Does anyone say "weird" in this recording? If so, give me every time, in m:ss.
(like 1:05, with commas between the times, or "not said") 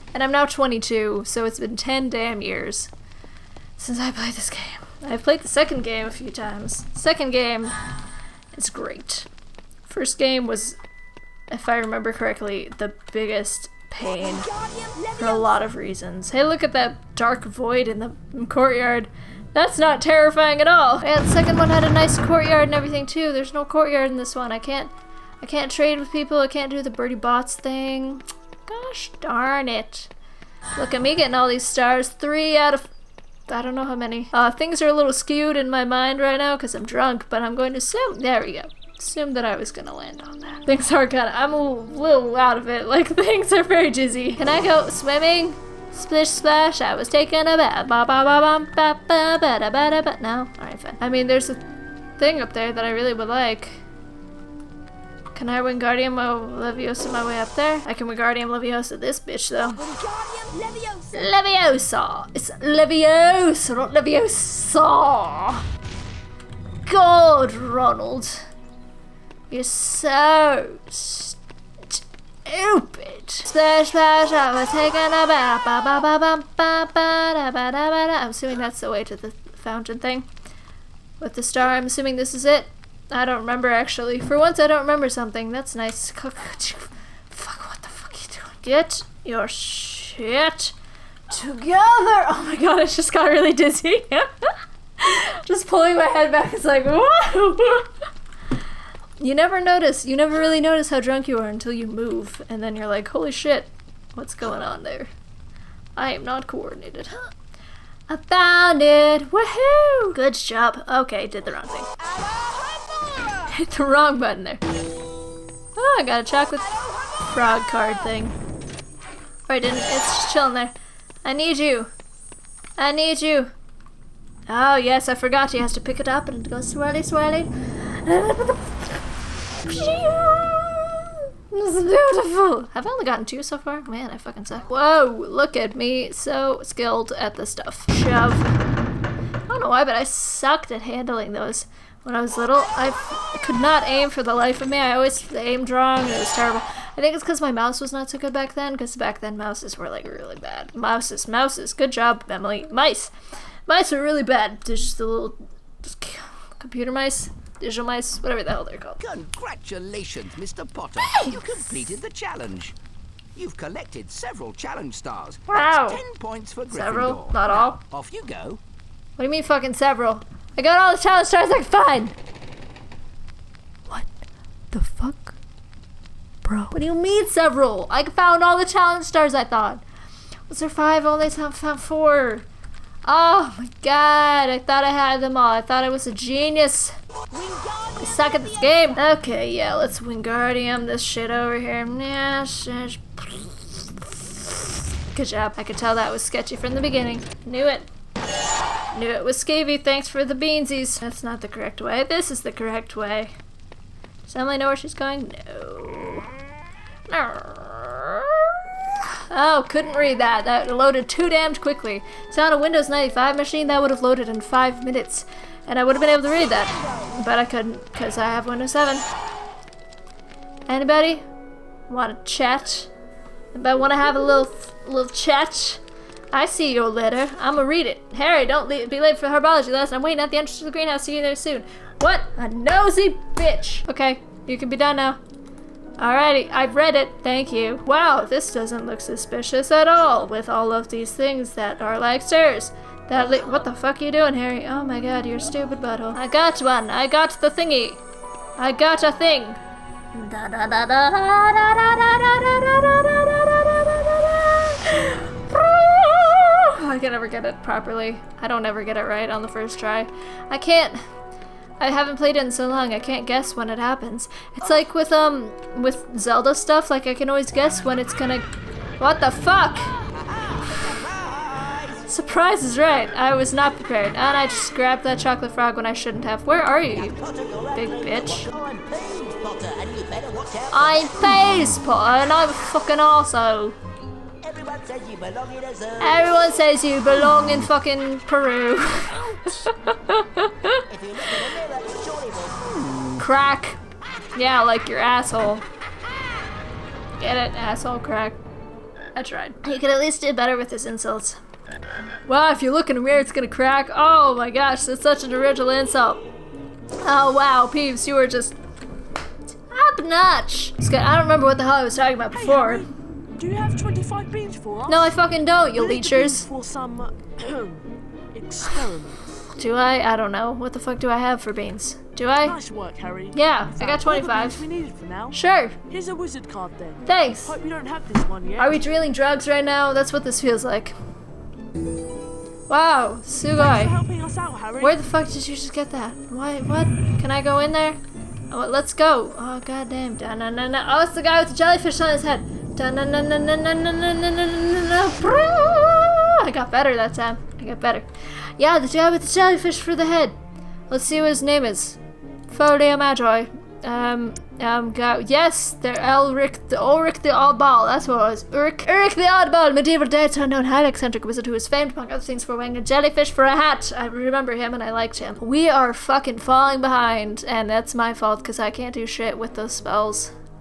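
5:03.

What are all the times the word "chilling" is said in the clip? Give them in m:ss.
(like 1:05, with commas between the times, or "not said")
2:00.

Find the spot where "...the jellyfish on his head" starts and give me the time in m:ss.
5:41.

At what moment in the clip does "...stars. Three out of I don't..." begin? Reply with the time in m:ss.
0:31.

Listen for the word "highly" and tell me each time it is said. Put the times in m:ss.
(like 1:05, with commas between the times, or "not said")
6:00.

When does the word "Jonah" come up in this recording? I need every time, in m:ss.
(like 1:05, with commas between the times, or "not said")
not said.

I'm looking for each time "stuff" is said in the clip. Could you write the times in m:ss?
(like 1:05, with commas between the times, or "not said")
2:17, 4:26.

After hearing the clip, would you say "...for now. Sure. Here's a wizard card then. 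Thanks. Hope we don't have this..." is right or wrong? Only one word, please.
right.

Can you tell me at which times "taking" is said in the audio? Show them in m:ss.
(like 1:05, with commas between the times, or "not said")
0:47, 1:14.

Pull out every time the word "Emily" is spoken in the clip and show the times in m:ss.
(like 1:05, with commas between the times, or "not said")
2:32, 3:24.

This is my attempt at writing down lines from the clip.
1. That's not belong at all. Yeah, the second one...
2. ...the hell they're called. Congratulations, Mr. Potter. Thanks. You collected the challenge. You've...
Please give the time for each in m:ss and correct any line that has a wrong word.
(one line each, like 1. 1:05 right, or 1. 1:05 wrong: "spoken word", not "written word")
1. 0:19 wrong: "terrifying", not "belong"
2. 2:38 wrong: "completed", not "collected".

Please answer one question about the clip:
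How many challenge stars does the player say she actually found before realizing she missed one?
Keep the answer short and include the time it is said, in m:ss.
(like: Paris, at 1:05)
4, at 3:01.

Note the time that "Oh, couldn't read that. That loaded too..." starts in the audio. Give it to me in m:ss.
3:29.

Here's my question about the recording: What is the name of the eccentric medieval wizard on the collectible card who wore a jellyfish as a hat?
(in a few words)
Uric the Oddball.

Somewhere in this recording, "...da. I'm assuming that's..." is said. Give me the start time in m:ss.
1:18.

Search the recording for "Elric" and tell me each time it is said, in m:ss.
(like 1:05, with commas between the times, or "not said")
5:55.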